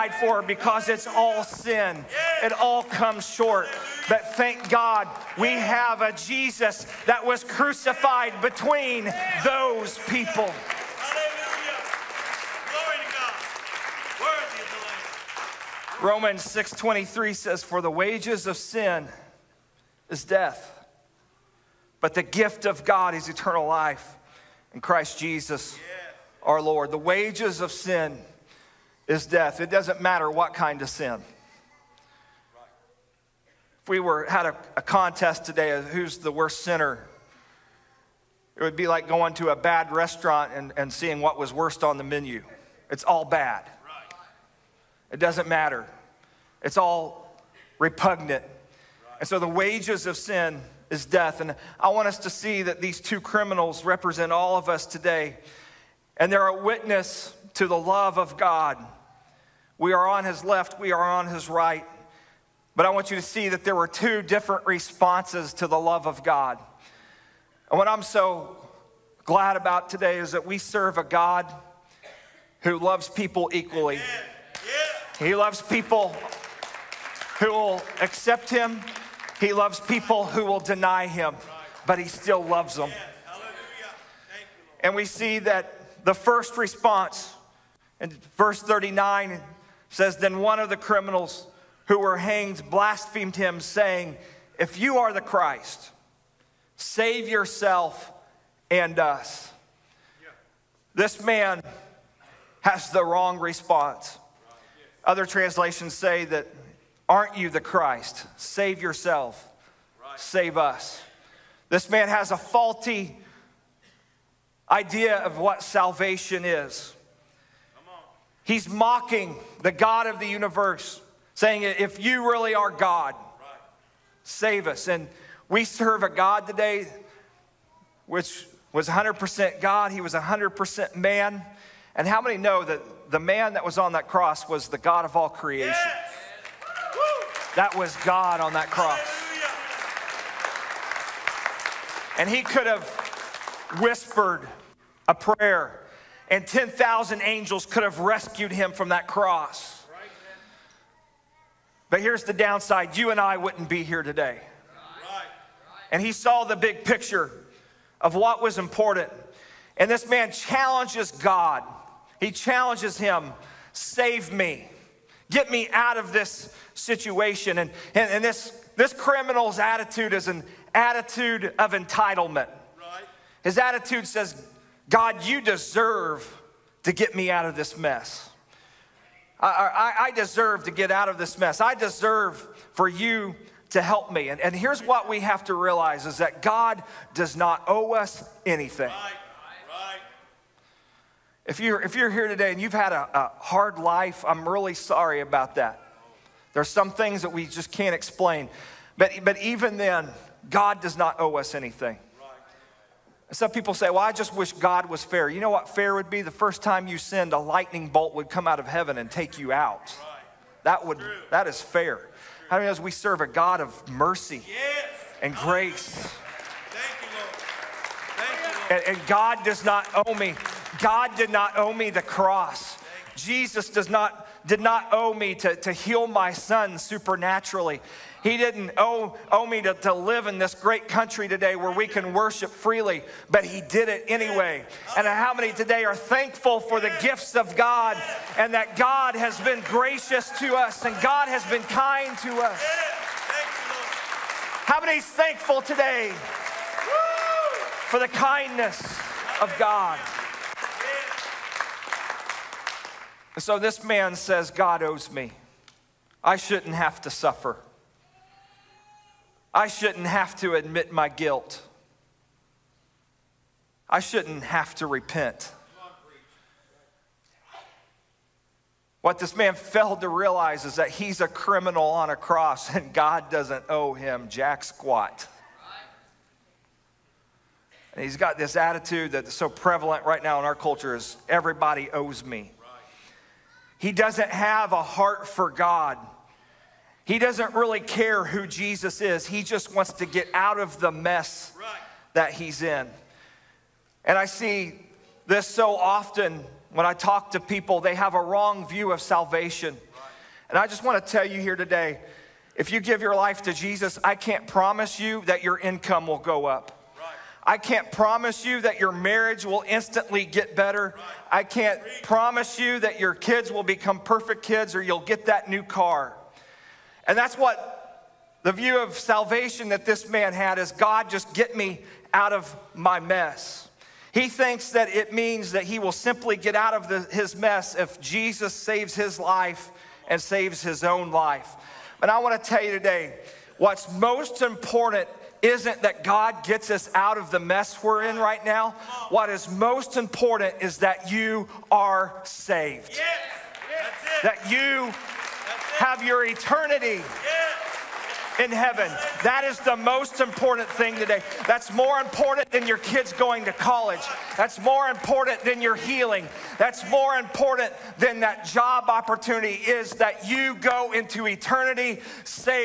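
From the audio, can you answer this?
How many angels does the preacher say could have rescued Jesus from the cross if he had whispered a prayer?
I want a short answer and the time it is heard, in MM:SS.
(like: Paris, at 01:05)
10,000, at 02:26.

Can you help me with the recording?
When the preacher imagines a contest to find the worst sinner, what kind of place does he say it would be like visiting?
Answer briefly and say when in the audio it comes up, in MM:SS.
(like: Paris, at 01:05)
a bad restaurant, at 00:39.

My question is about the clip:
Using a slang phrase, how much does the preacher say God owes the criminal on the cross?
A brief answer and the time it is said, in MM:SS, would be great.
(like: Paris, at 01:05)
jack squat, at 04:34.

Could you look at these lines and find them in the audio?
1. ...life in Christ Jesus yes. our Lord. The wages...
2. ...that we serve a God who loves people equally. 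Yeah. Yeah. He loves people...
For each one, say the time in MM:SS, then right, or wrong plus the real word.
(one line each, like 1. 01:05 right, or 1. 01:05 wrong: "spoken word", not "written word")
1. 00:23 right
2. 01:10 right.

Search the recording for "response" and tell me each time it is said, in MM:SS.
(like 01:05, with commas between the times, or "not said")
01:04, 01:26, 01:43.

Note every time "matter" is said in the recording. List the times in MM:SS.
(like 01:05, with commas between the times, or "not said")
00:30, 00:45.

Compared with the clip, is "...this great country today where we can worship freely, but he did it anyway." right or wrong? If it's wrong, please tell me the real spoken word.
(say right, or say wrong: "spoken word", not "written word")
right.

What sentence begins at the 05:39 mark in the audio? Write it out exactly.
What is most important is that you are saved.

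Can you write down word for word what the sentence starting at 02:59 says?
I, I, I deserve to get out of this mess.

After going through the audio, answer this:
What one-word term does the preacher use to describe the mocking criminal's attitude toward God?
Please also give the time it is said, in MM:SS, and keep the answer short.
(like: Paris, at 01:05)
entitlement, at 02:51.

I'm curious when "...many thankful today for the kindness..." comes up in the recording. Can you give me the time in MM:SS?
04:04.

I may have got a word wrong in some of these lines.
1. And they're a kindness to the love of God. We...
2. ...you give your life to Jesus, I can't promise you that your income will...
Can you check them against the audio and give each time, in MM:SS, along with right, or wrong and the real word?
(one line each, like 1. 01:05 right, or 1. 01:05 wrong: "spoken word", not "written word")
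1. 00:56 wrong: "witness", not "kindness"
2. 05:02 right.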